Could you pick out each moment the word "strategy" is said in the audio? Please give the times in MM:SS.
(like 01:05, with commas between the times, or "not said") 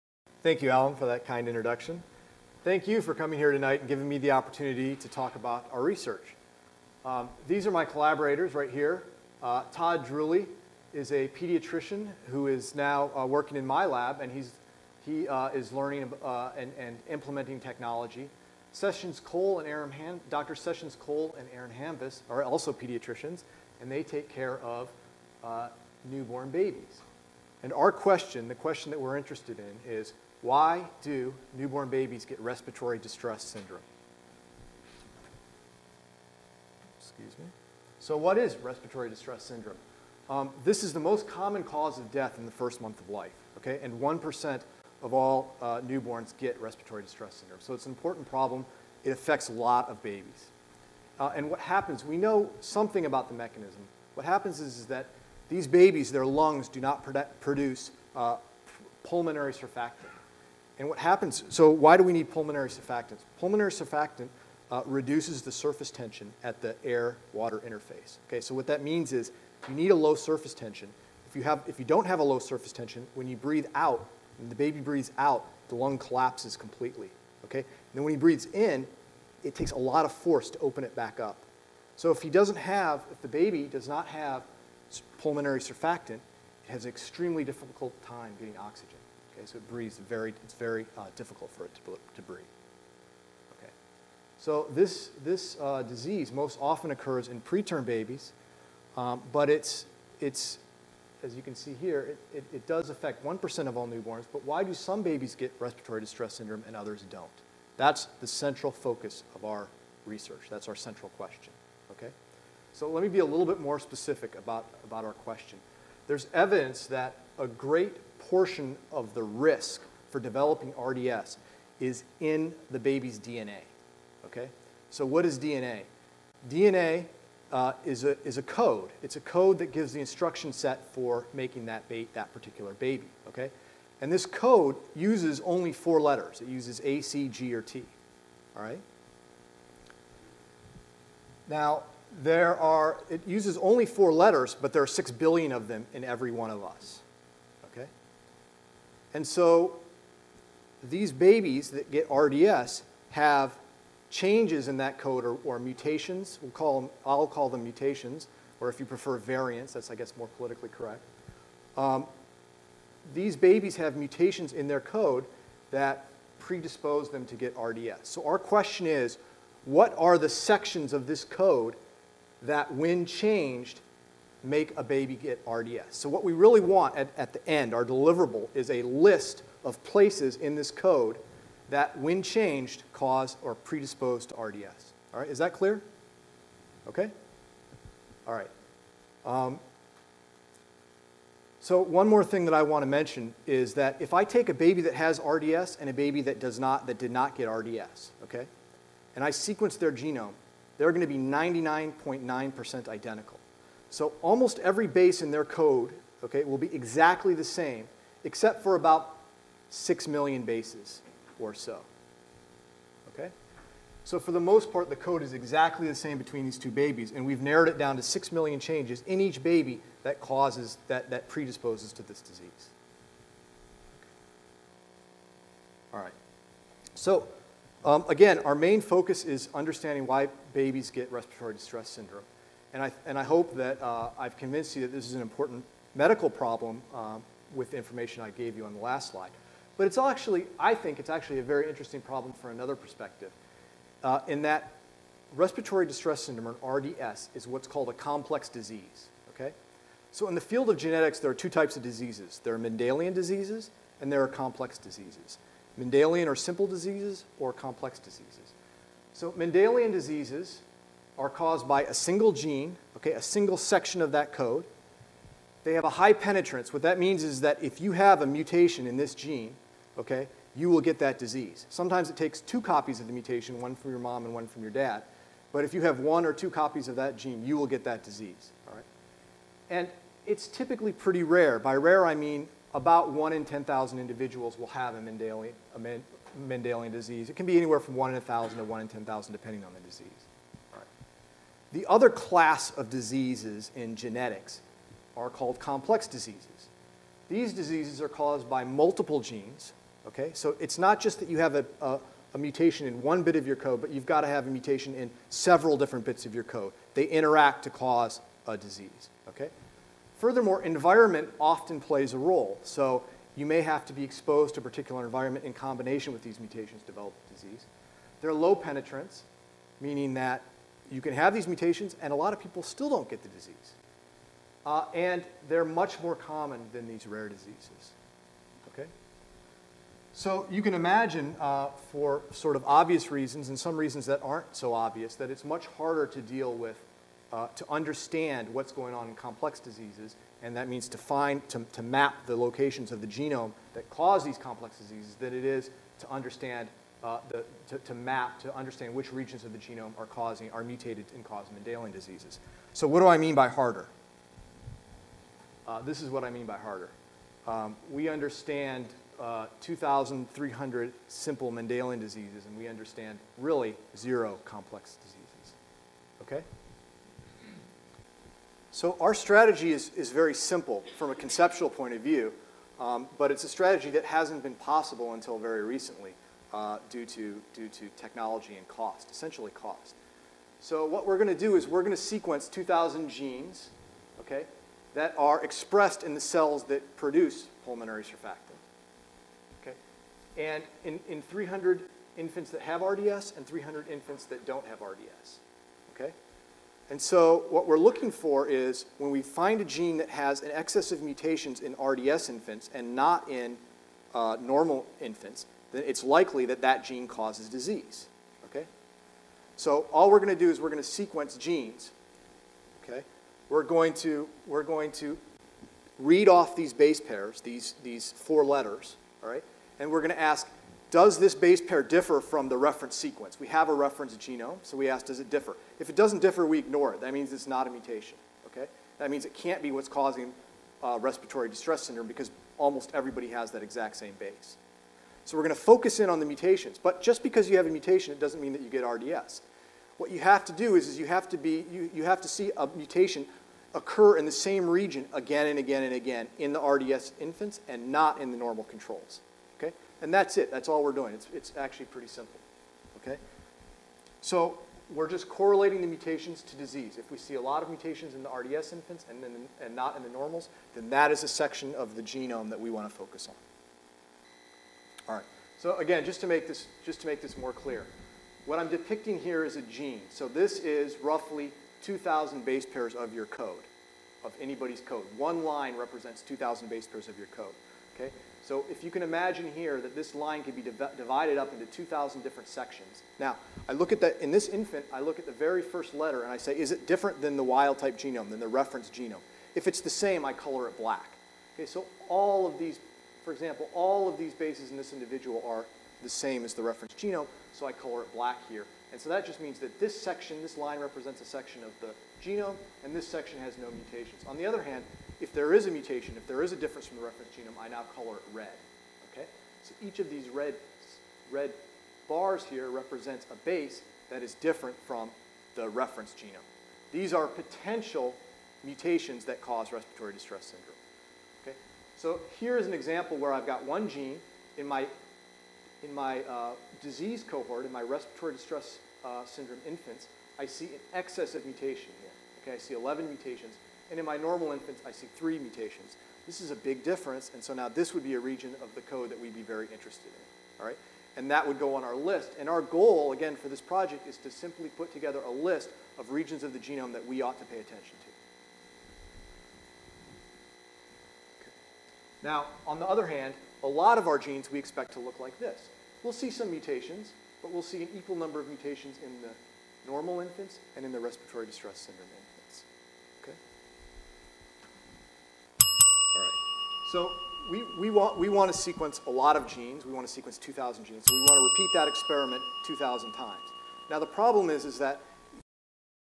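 06:09, 06:13.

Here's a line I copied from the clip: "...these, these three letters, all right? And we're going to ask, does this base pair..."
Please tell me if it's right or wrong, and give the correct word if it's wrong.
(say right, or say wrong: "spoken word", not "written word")
wrong: "four", not "three".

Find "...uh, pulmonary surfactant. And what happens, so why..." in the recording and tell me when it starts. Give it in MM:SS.
00:58.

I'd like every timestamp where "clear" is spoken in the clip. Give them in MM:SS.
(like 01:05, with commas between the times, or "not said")
03:05, 07:47.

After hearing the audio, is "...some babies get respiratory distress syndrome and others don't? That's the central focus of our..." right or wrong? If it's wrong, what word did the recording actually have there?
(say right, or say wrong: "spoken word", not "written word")
right.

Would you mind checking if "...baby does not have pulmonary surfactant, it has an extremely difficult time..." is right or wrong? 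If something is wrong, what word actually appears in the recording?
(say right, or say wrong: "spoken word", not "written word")
right.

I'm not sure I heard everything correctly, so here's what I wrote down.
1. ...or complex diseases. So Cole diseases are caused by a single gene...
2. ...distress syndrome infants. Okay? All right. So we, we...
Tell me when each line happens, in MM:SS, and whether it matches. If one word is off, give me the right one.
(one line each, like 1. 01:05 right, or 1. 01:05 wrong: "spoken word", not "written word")
1. 04:17 wrong: "Mendelian", not "Cole"
2. 09:21 right.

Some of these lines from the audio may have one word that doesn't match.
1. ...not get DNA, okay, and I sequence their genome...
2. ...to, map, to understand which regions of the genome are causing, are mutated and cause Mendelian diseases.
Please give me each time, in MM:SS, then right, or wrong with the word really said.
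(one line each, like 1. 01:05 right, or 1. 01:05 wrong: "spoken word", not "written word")
1. 03:17 wrong: "RDS", not "DNA"
2. 05:47 right.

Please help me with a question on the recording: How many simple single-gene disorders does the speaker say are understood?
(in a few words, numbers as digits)
2,300.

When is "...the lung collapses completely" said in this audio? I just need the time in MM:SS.
01:15.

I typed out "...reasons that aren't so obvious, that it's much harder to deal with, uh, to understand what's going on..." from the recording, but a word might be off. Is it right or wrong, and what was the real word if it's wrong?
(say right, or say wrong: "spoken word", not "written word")
right.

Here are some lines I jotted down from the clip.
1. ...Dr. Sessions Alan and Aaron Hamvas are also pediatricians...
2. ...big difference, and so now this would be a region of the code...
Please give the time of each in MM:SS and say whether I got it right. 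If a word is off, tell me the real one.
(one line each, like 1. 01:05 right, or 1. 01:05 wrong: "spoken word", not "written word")
1. 00:20 wrong: "Cole", not "Alan"
2. 08:56 right.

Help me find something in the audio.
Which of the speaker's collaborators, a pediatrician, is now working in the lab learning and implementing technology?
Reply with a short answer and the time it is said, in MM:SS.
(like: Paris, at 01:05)
Todd Druley, at 00:09.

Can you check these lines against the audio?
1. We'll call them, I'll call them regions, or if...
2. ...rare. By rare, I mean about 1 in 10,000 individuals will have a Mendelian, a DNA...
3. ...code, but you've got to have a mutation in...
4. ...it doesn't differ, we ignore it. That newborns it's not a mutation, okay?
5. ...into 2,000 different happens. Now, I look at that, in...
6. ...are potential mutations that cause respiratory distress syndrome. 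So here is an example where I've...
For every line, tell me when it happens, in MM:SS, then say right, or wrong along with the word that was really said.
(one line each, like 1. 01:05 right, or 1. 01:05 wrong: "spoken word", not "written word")
1. 02:36 wrong: "mutations", not "regions"
2. 04:41 wrong: "Mendelian", not "DNA"
3. 05:03 right
4. 07:05 wrong: "means", not "newborns"
5. 08:01 wrong: "sections", not "happens"
6. 08:37 right.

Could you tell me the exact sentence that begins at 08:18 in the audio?
And so that just means that this section, this line represents a section of the genome, and this section has no mutations.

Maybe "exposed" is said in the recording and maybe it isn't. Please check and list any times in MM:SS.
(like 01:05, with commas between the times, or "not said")
05:14.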